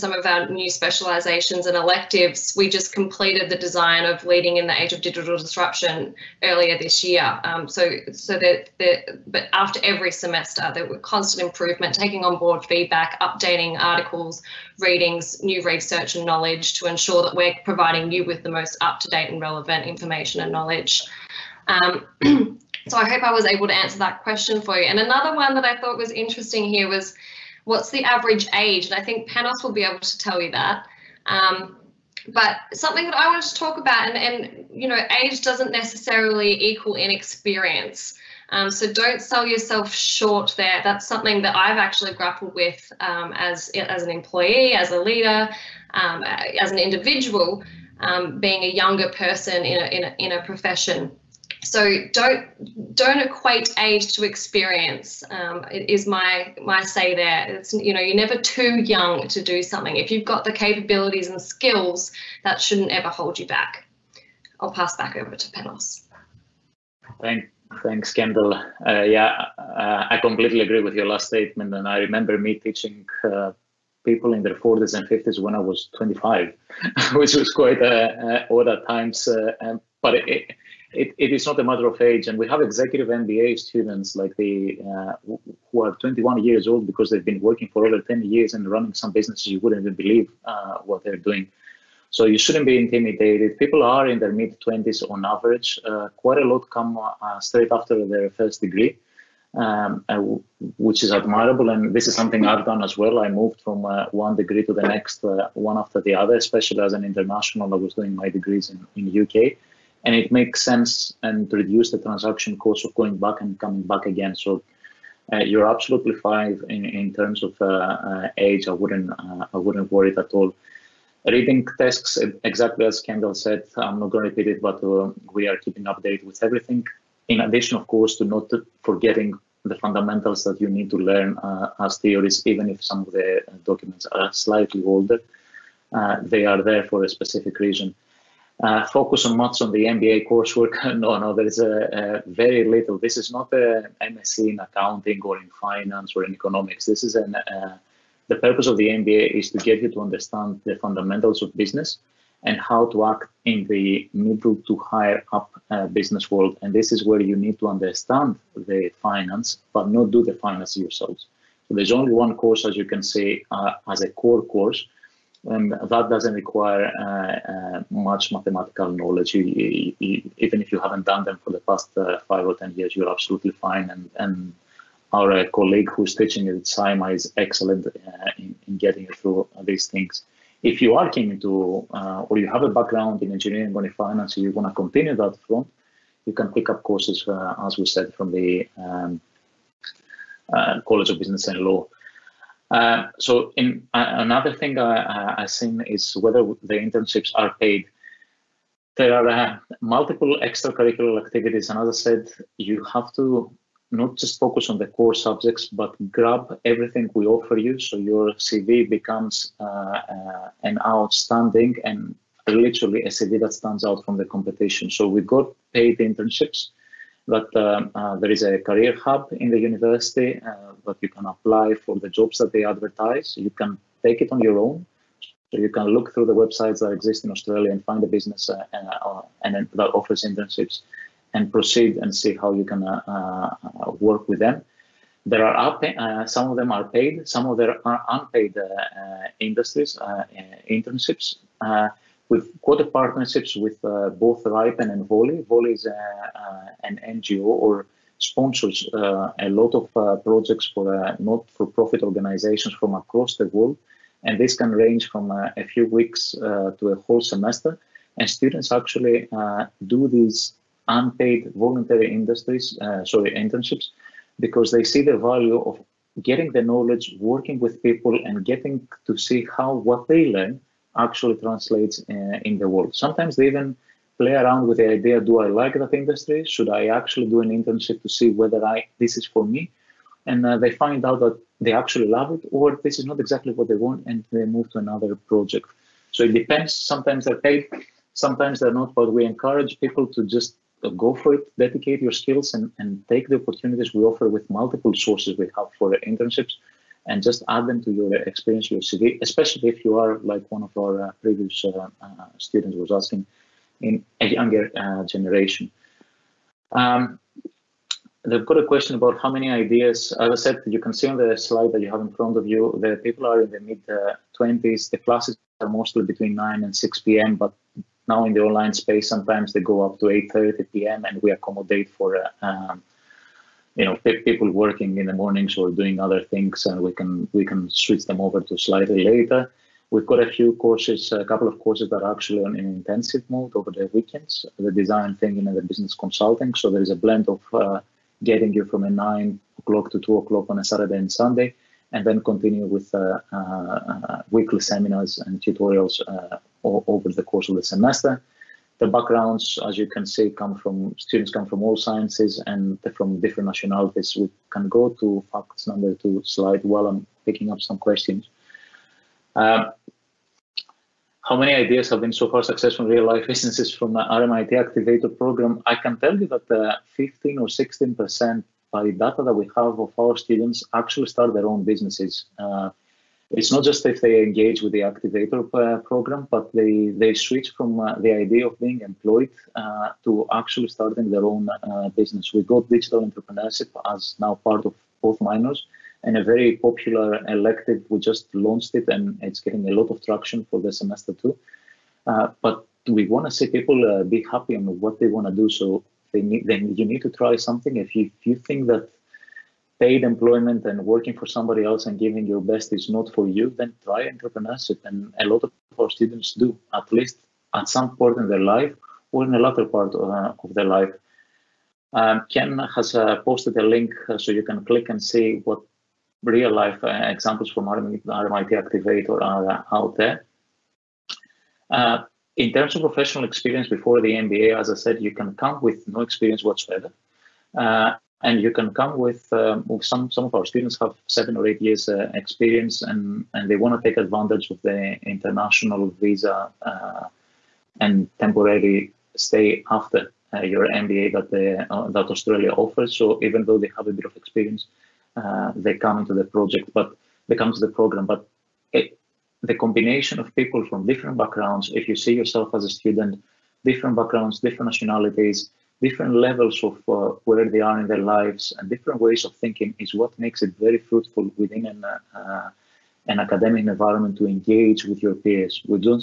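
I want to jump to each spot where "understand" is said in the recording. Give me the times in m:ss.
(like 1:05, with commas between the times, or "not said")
2:29, 2:37.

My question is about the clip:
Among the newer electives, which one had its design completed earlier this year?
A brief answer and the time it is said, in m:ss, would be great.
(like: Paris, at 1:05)
Leading in the Age of Digital Disruption, at 0:04.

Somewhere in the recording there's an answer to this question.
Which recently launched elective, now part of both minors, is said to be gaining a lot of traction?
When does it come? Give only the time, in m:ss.
6:22.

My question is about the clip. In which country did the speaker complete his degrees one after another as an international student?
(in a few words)
UK.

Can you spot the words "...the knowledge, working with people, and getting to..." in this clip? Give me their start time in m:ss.
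4:26.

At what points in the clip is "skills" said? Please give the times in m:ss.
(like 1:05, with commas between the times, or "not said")
1:01, 4:52.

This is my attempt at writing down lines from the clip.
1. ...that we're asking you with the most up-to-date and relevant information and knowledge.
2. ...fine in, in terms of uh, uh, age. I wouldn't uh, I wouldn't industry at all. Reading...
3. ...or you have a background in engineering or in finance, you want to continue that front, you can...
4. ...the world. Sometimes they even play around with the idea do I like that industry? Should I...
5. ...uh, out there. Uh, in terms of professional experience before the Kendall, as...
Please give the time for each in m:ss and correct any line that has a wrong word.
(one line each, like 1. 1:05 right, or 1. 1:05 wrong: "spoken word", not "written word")
1. 0:17 wrong: "providing", not "asking"
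2. 1:56 wrong: "worry", not "industry"
3. 3:02 right
4. 4:32 right
5. 6:59 wrong: "MBA", not "Kendall".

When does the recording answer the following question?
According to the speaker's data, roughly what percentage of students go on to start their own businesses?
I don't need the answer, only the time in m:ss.
6:06.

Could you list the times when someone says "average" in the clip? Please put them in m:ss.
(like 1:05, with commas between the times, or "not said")
0:28, 1:35.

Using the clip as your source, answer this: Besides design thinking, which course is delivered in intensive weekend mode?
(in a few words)
business consulting.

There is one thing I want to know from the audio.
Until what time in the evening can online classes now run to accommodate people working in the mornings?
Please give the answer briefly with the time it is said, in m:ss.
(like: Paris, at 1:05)
8.30 p.m., at 5:20.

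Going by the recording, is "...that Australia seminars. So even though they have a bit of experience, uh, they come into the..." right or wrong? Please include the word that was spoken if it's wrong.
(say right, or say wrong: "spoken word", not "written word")
wrong: "offers", not "seminars".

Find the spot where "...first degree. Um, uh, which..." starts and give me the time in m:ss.
1:38.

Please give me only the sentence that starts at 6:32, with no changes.
Uh, but we want to see people uh, be happy on what they want to do.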